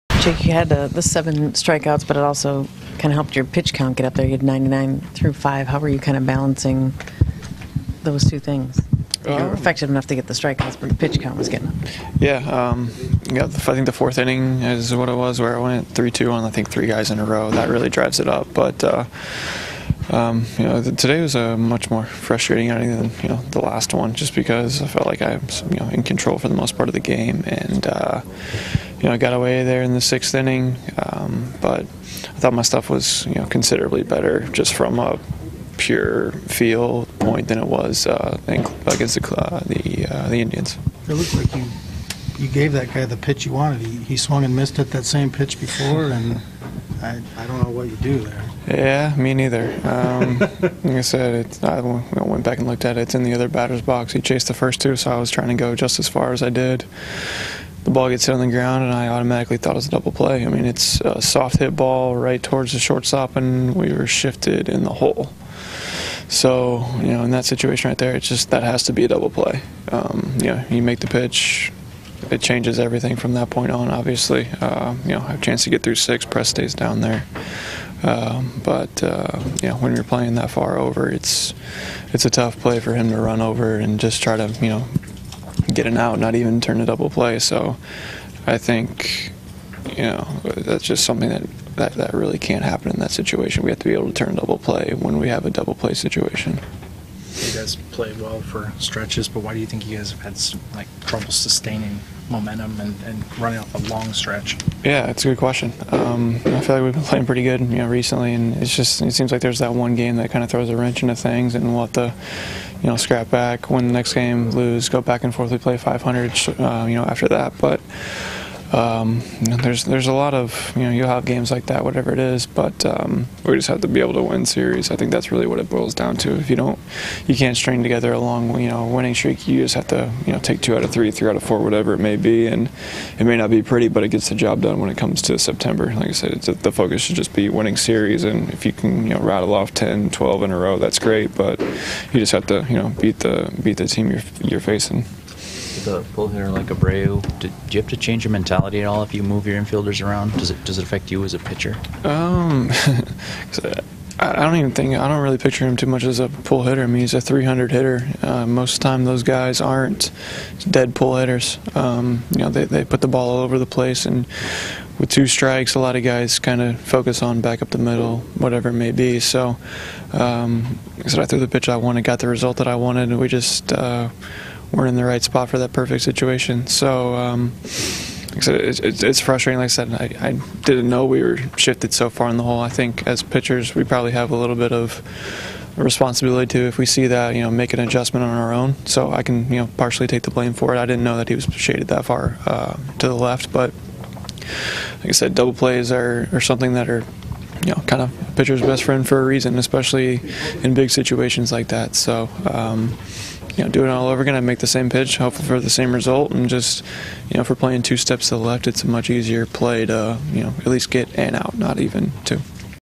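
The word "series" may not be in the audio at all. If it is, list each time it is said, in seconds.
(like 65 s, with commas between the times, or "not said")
124 s, 137 s.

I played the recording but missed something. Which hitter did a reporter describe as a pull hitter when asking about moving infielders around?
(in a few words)
Abreu.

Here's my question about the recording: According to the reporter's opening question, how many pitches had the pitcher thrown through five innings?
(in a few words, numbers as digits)
99.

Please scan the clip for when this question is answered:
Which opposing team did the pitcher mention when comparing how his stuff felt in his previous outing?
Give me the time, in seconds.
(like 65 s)
40 s.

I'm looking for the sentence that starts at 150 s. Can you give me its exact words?
Does it does it affect you as a pitcher?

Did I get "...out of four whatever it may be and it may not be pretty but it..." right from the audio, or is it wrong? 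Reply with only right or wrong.
right.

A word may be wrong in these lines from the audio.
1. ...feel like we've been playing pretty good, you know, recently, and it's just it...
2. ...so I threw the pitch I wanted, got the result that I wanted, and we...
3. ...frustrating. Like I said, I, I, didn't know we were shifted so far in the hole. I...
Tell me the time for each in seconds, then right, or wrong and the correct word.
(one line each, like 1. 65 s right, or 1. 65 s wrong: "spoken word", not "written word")
1. 106 s right
2. 171 s right
3. 179 s right.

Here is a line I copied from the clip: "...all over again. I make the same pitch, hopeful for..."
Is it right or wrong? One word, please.
right.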